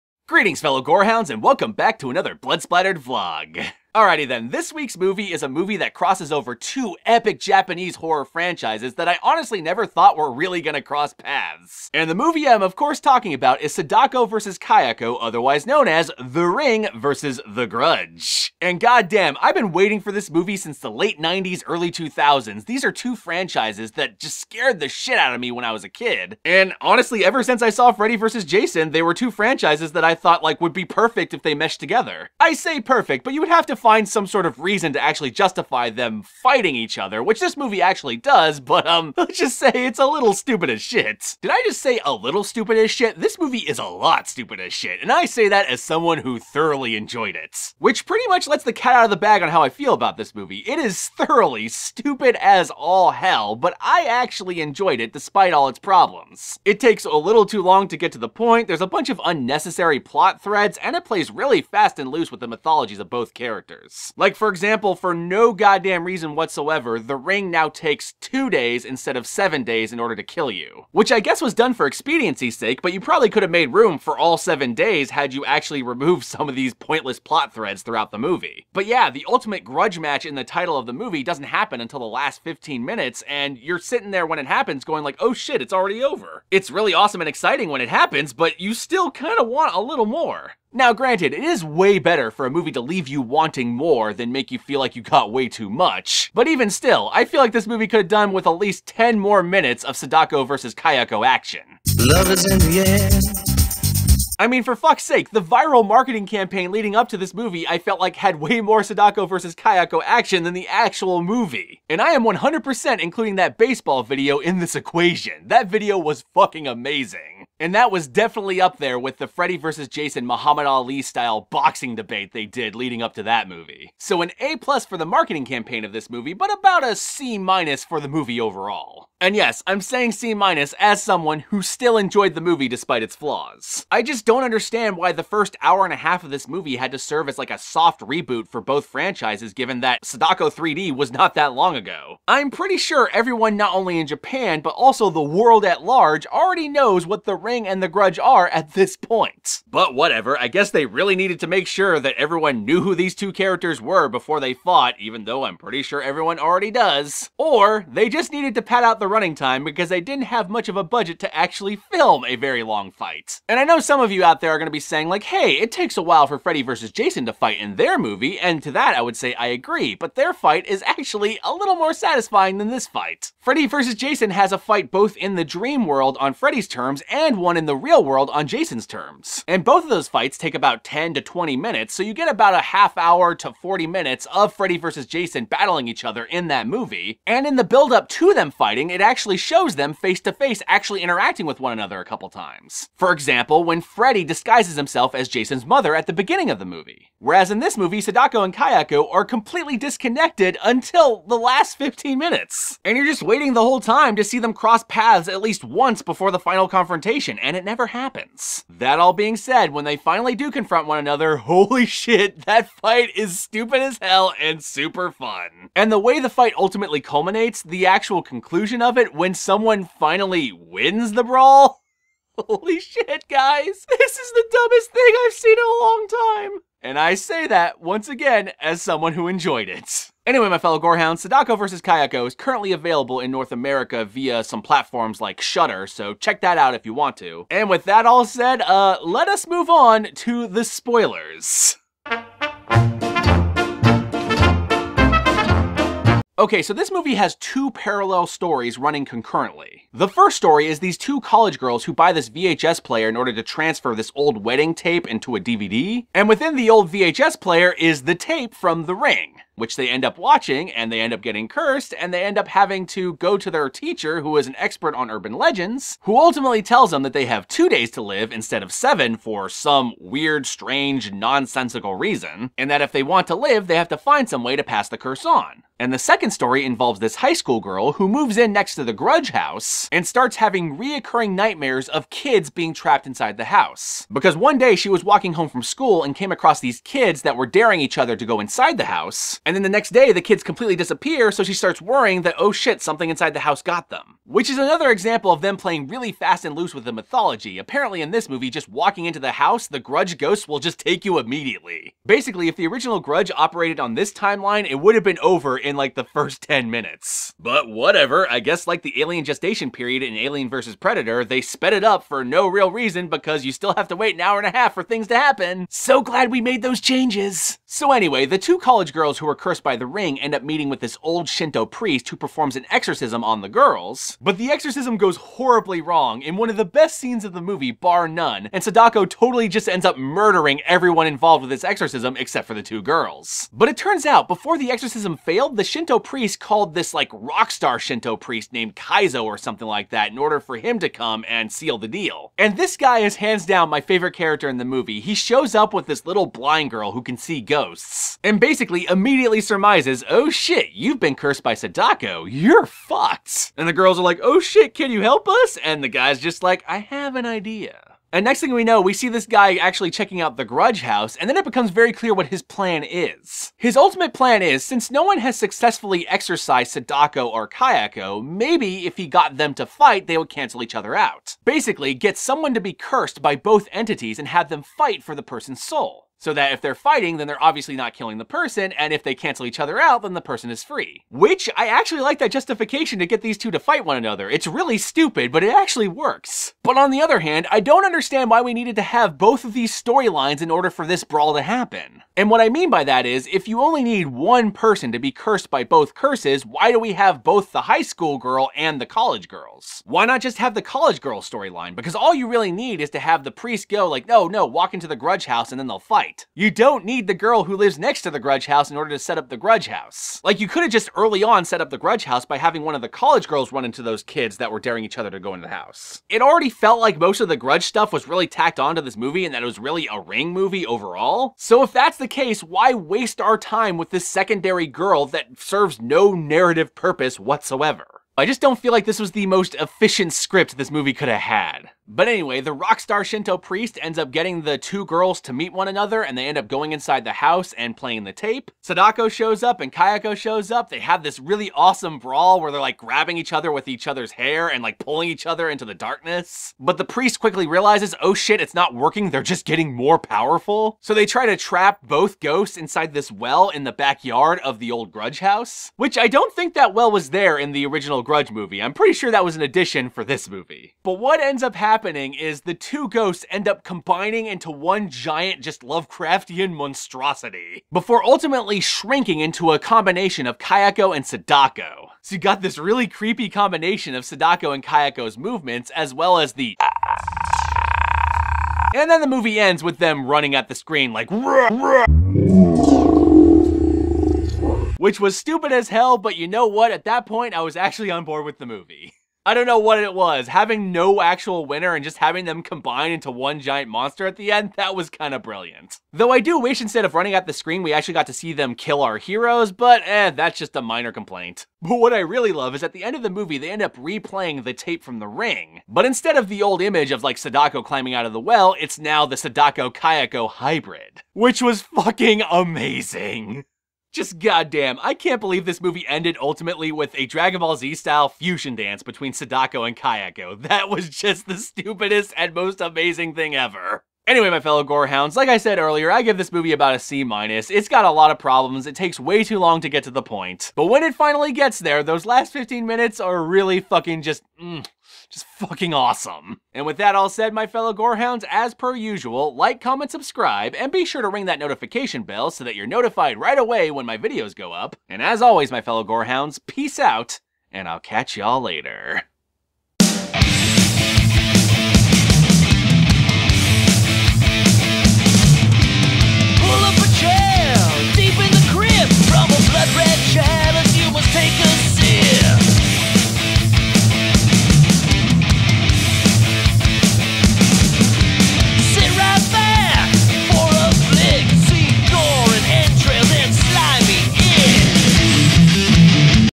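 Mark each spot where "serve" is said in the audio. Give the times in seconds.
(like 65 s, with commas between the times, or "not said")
136 s, 425 s.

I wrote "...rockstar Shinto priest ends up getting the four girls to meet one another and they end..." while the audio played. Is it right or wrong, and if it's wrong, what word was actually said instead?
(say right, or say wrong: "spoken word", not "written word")
wrong: "two", not "four".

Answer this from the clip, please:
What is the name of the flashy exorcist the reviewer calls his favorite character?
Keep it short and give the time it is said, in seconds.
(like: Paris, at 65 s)
Kaizo, at 338 s.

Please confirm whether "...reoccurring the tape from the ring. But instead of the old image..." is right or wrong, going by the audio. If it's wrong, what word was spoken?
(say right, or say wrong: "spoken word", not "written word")
wrong: "replaying", not "reoccurring".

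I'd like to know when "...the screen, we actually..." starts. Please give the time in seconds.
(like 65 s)
497 s.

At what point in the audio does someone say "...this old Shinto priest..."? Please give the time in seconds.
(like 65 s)
320 s.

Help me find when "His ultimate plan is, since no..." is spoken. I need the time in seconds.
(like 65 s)
363 s.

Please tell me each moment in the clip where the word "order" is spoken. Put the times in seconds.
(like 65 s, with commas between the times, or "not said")
70 s, 253 s, 340 s, 390 s, 408 s.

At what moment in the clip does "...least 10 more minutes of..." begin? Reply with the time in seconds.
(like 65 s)
98 s.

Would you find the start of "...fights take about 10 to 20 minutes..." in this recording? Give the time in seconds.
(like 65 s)
180 s.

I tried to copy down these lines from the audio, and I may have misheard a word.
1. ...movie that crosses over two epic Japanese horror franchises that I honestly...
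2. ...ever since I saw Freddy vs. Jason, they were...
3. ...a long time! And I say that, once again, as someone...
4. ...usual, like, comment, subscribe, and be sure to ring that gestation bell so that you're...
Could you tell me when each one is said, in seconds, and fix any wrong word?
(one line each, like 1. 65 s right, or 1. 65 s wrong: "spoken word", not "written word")
1. 5 s right
2. 27 s right
3. 225 s right
4. 538 s wrong: "notification", not "gestation".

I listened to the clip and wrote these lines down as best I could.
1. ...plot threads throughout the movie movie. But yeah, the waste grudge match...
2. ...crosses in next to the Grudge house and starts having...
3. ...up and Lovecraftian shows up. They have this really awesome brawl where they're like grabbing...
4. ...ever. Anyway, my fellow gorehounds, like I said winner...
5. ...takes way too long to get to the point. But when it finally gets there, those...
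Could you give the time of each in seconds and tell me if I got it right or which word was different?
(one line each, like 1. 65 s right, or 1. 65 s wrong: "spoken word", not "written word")
1. 77 s wrong: "ultimate", not "waste"
2. 278 s wrong: "moves", not "crosses"
3. 439 s wrong: "Kayako", not "Lovecraftian"
4. 523 s wrong: "earlier", not "winner"
5. 528 s right.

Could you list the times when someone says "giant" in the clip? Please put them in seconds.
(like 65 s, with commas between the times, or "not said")
464 s, 493 s.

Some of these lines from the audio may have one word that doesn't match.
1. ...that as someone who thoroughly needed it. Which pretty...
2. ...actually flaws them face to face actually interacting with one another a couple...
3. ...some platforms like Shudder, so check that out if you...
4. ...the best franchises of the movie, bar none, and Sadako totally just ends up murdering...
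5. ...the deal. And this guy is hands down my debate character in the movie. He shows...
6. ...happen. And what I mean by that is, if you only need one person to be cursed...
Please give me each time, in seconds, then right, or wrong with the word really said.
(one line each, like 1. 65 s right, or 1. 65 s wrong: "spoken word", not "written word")
1. 45 s wrong: "enjoyed", not "needed"
2. 189 s wrong: "shows", not "flaws"
3. 234 s right
4. 326 s wrong: "scenes", not "franchises"
5. 341 s wrong: "favorite", not "debate"
6. 391 s right.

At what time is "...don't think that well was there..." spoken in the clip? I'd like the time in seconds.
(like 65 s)
456 s.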